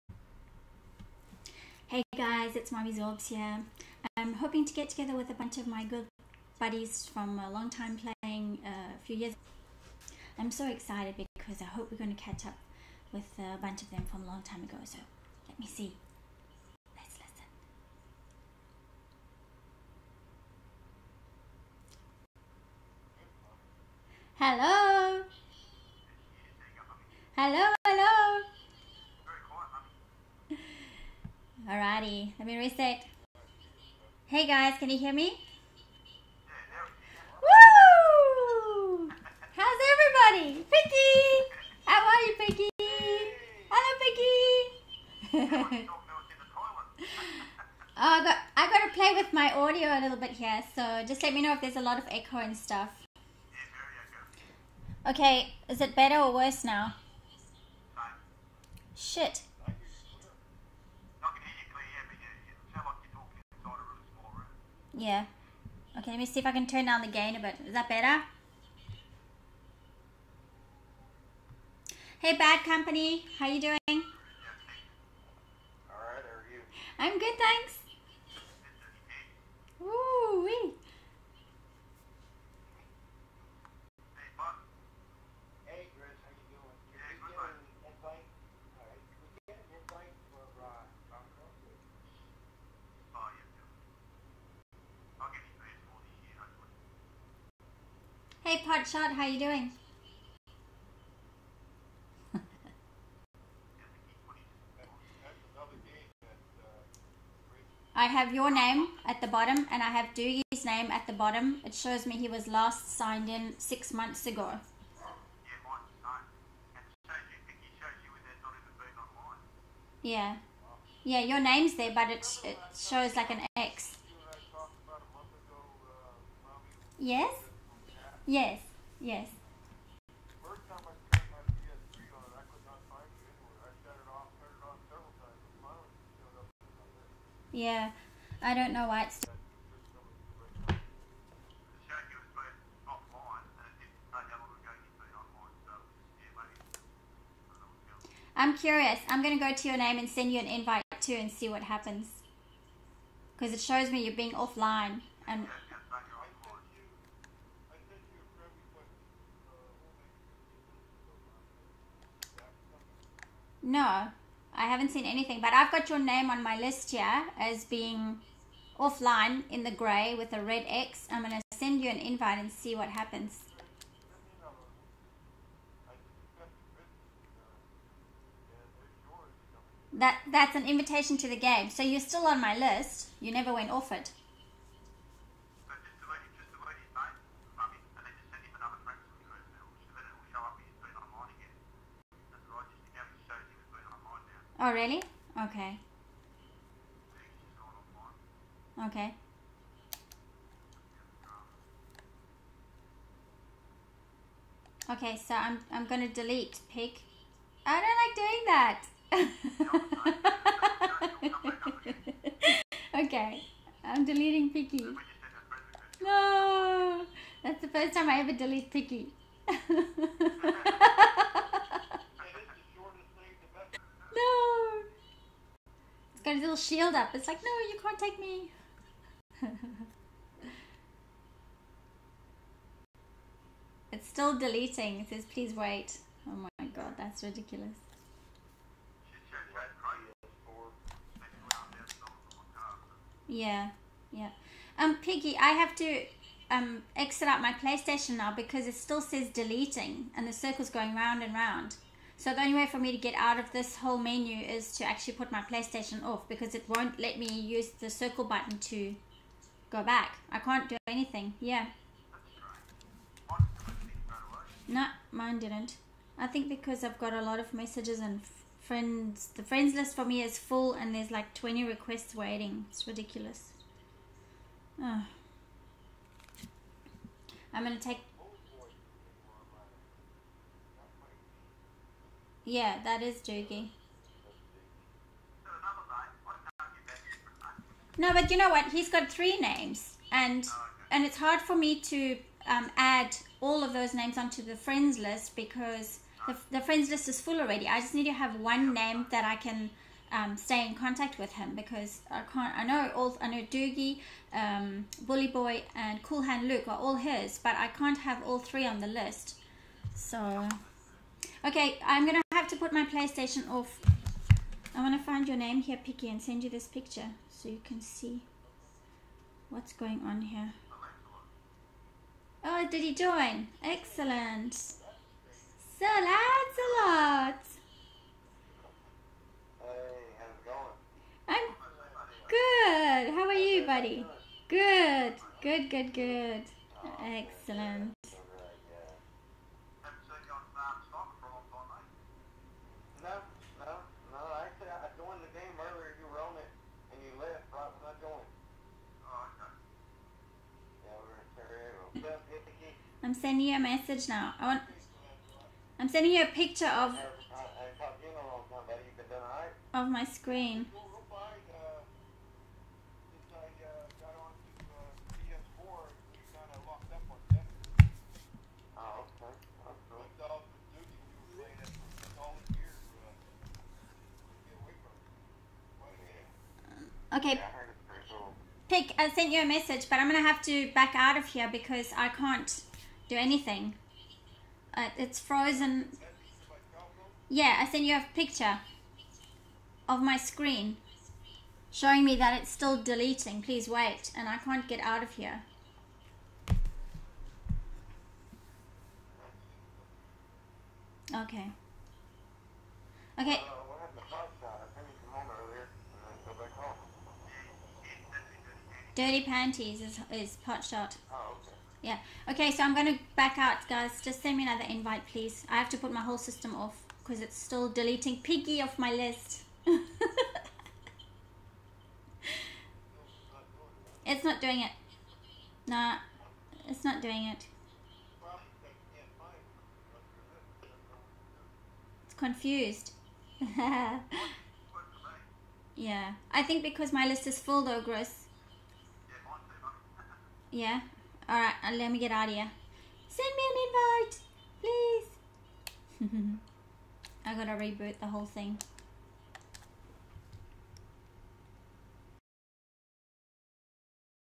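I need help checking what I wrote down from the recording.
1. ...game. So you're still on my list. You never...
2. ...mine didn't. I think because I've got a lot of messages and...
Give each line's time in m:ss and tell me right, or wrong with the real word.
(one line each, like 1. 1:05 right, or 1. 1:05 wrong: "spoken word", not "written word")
1. 3:01 right
2. 4:25 right.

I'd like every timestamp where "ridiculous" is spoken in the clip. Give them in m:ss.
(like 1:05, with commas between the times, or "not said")
3:57, 4:32.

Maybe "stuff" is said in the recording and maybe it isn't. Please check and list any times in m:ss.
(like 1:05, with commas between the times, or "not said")
0:52.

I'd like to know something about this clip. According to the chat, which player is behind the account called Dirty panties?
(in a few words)
Potshot.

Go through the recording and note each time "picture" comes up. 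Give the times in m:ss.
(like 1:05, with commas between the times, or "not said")
5:16, 5:56, 6:28.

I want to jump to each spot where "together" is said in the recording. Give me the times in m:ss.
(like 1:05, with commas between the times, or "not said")
0:04.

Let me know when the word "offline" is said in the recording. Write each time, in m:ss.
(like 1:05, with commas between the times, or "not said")
2:34, 2:48.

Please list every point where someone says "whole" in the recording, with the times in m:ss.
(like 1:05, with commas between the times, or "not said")
4:13, 6:56, 7:28.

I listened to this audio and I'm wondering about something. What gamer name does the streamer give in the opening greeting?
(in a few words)
MOMMYZORBZ.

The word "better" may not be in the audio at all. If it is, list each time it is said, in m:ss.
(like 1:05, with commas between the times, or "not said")
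0:55, 1:07.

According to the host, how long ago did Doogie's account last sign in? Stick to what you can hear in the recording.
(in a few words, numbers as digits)
6 months.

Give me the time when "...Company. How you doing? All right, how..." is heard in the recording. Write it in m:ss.
1:12.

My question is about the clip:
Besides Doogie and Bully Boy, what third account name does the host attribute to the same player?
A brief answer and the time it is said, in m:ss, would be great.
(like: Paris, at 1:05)
Cool Hand Luke, at 5:06.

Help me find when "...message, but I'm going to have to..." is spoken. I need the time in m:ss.
6:19.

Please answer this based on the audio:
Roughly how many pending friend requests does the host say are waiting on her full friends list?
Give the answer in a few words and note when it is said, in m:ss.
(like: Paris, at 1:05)
20, at 4:31.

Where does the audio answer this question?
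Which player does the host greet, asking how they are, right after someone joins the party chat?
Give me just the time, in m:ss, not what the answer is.
5:26.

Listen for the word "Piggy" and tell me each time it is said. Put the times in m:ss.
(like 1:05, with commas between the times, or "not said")
4:04, 6:58.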